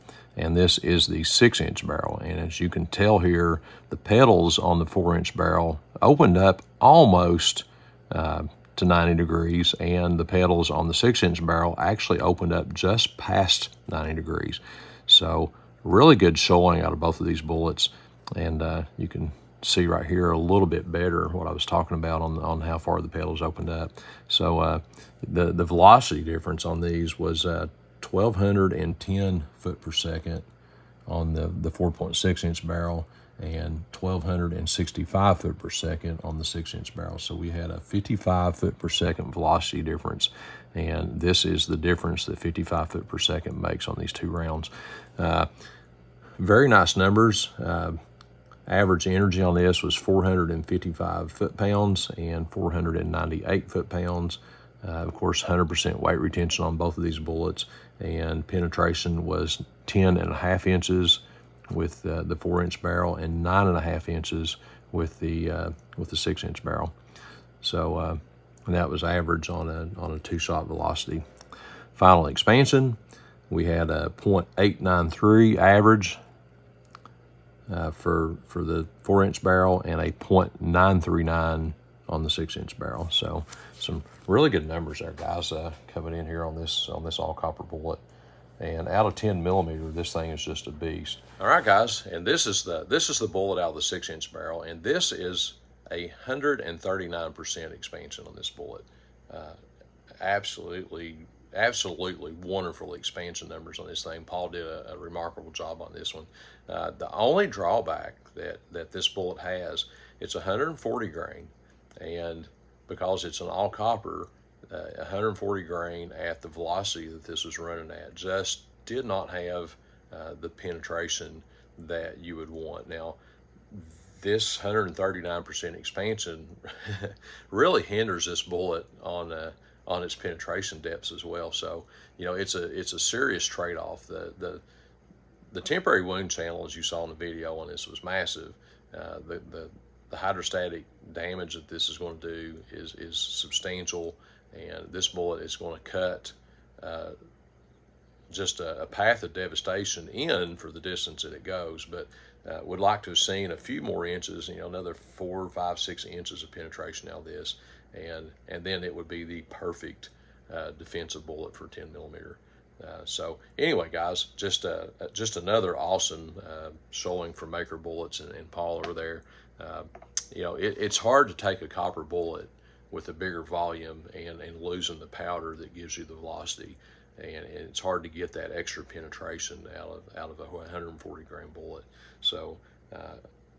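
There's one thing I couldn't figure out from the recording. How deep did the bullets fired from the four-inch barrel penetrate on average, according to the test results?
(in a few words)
10.5 inches.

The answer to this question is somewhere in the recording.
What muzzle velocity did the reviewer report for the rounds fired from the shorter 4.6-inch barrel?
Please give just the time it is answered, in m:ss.
0:28.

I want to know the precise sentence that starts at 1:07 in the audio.
So uh, that was average on a on a two shot velocity.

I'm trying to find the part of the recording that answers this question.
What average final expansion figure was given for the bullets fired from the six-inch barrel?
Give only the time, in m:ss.
1:20.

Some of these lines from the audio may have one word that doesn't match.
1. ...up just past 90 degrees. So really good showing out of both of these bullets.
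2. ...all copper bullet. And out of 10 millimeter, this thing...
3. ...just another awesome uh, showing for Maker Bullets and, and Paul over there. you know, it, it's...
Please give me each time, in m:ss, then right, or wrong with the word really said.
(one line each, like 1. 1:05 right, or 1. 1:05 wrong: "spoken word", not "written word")
1. 0:12 right
2. 1:27 right
3. 2:45 right.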